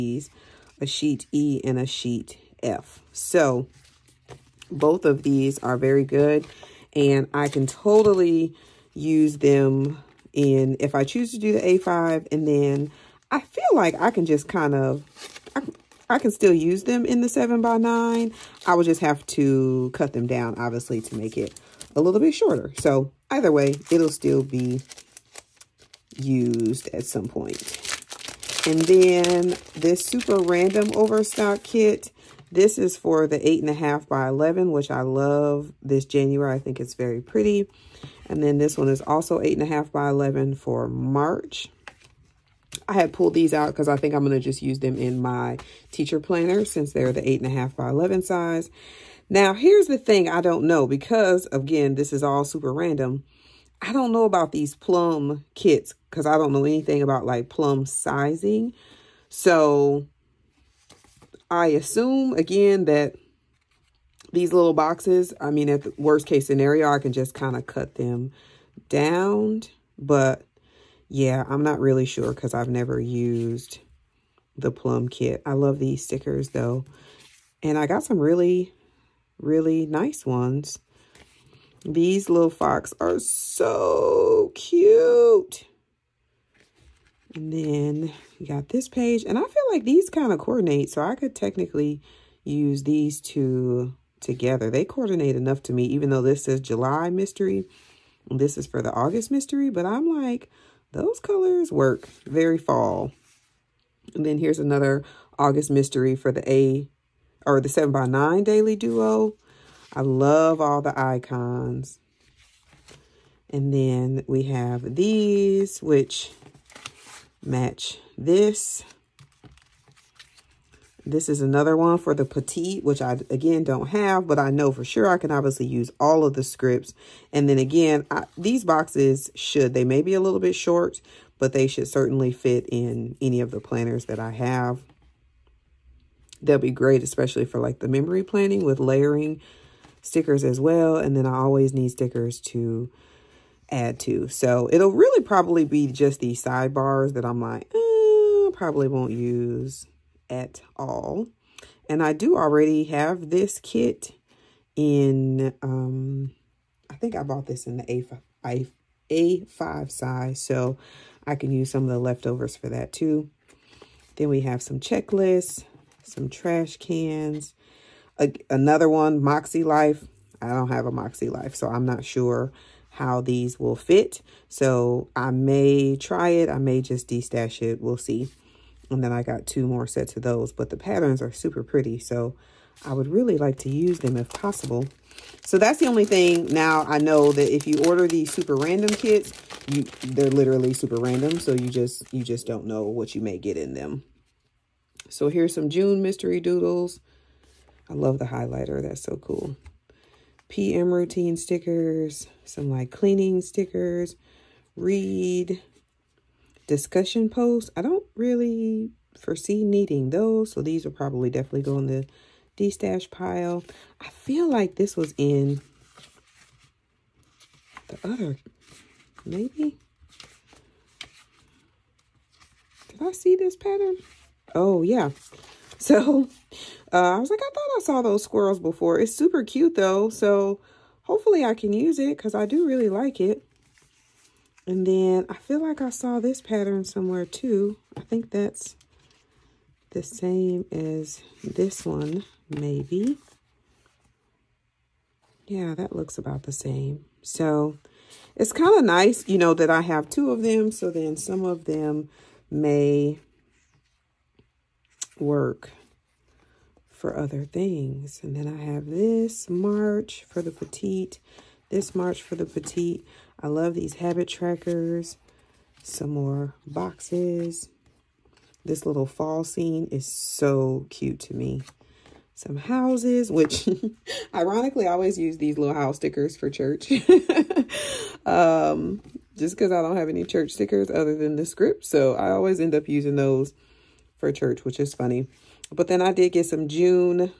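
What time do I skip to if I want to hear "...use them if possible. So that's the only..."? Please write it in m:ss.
3:03.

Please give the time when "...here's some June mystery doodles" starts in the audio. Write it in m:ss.
3:15.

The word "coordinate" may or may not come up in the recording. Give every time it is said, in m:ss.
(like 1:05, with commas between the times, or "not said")
1:30, 1:34.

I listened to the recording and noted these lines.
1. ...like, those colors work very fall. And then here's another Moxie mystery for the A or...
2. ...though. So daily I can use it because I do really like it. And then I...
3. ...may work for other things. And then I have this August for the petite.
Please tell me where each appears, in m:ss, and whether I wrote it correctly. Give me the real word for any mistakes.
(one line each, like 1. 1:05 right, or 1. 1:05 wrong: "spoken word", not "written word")
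1. 1:40 wrong: "August", not "Moxie"
2. 3:49 wrong: "hopefully", not "daily"
3. 4:12 wrong: "March", not "August".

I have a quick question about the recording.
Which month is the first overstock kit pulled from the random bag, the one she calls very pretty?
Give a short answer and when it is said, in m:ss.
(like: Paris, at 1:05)
January, at 0:36.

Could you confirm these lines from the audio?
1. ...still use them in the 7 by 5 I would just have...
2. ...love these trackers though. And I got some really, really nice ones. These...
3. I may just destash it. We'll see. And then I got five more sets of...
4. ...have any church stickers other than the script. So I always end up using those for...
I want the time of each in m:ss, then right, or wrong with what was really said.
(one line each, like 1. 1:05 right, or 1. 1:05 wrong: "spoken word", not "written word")
1. 0:16 wrong: "9", not "5"
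2. 1:15 wrong: "stickers", not "trackers"
3. 2:56 wrong: "two", not "five"
4. 4:39 right.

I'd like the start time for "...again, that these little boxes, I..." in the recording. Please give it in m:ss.
1:02.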